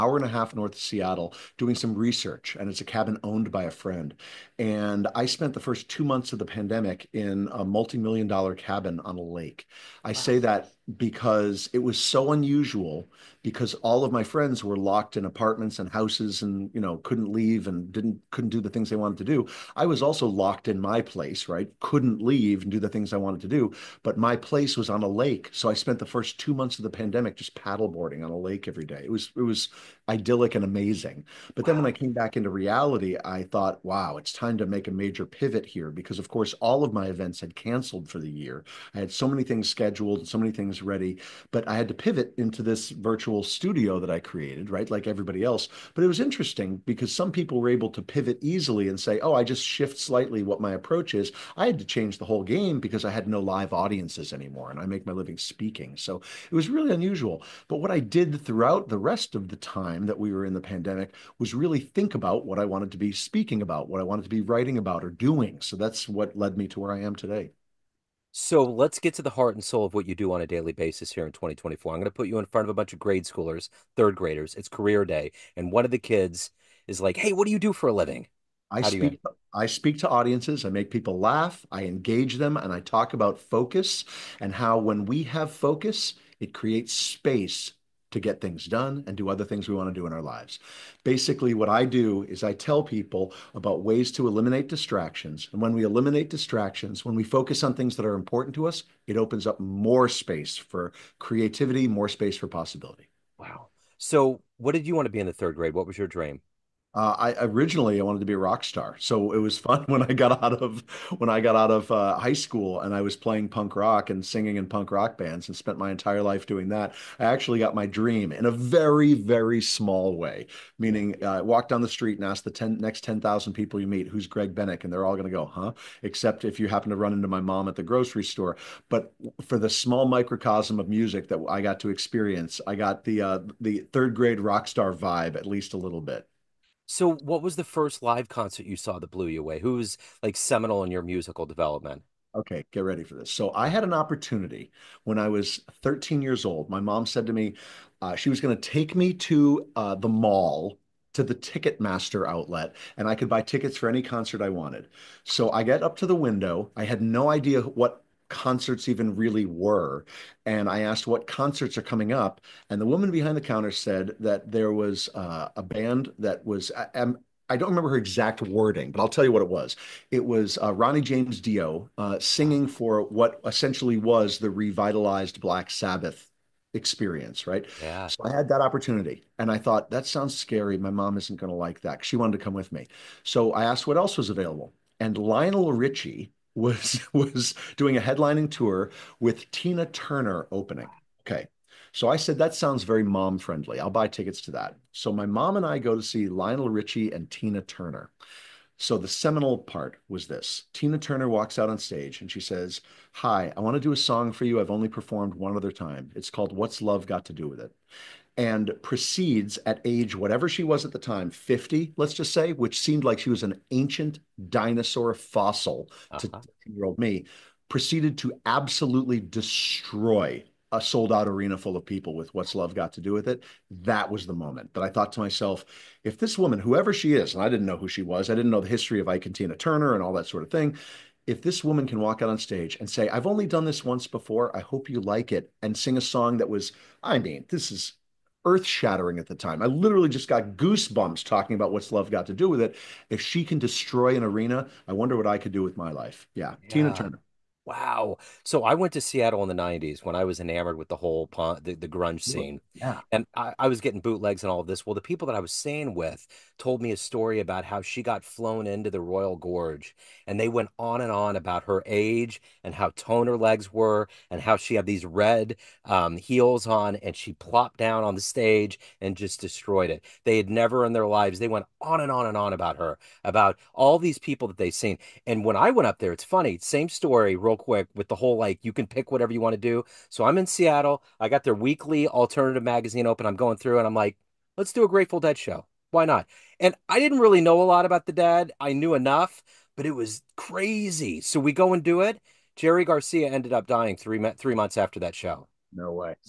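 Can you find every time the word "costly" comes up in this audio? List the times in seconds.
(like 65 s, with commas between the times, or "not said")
not said.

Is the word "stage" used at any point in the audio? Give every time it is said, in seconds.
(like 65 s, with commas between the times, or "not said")
201 s, 232 s, 268 s.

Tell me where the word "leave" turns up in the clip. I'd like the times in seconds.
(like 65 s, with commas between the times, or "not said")
17 s, 22 s.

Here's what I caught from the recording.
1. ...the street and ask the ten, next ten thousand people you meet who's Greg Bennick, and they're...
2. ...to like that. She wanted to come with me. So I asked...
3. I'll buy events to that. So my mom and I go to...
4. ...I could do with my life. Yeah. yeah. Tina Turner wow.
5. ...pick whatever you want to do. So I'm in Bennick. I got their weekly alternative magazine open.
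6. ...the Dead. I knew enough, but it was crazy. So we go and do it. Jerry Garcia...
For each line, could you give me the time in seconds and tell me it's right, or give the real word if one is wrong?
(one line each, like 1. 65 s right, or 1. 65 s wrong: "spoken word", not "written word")
1. 121 s right
2. 181 s right
3. 193 s wrong: "tickets", not "events"
4. 245 s right
5. 278 s wrong: "Seattle", not "Bennick"
6. 288 s right.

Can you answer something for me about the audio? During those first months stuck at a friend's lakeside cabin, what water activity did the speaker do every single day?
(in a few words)
Paddleboarding.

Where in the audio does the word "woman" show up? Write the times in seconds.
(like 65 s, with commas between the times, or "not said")
162 s, 226 s, 231 s.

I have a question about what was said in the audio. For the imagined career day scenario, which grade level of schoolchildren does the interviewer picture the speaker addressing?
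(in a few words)
Third graders.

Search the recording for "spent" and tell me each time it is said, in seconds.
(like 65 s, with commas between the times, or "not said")
5 s, 25 s, 115 s.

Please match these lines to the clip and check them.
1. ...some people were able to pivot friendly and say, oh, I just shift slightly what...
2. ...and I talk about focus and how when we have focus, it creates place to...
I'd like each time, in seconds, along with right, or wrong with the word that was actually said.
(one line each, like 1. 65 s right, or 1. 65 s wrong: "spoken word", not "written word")
1. 47 s wrong: "easily", not "friendly"
2. 82 s wrong: "space", not "place".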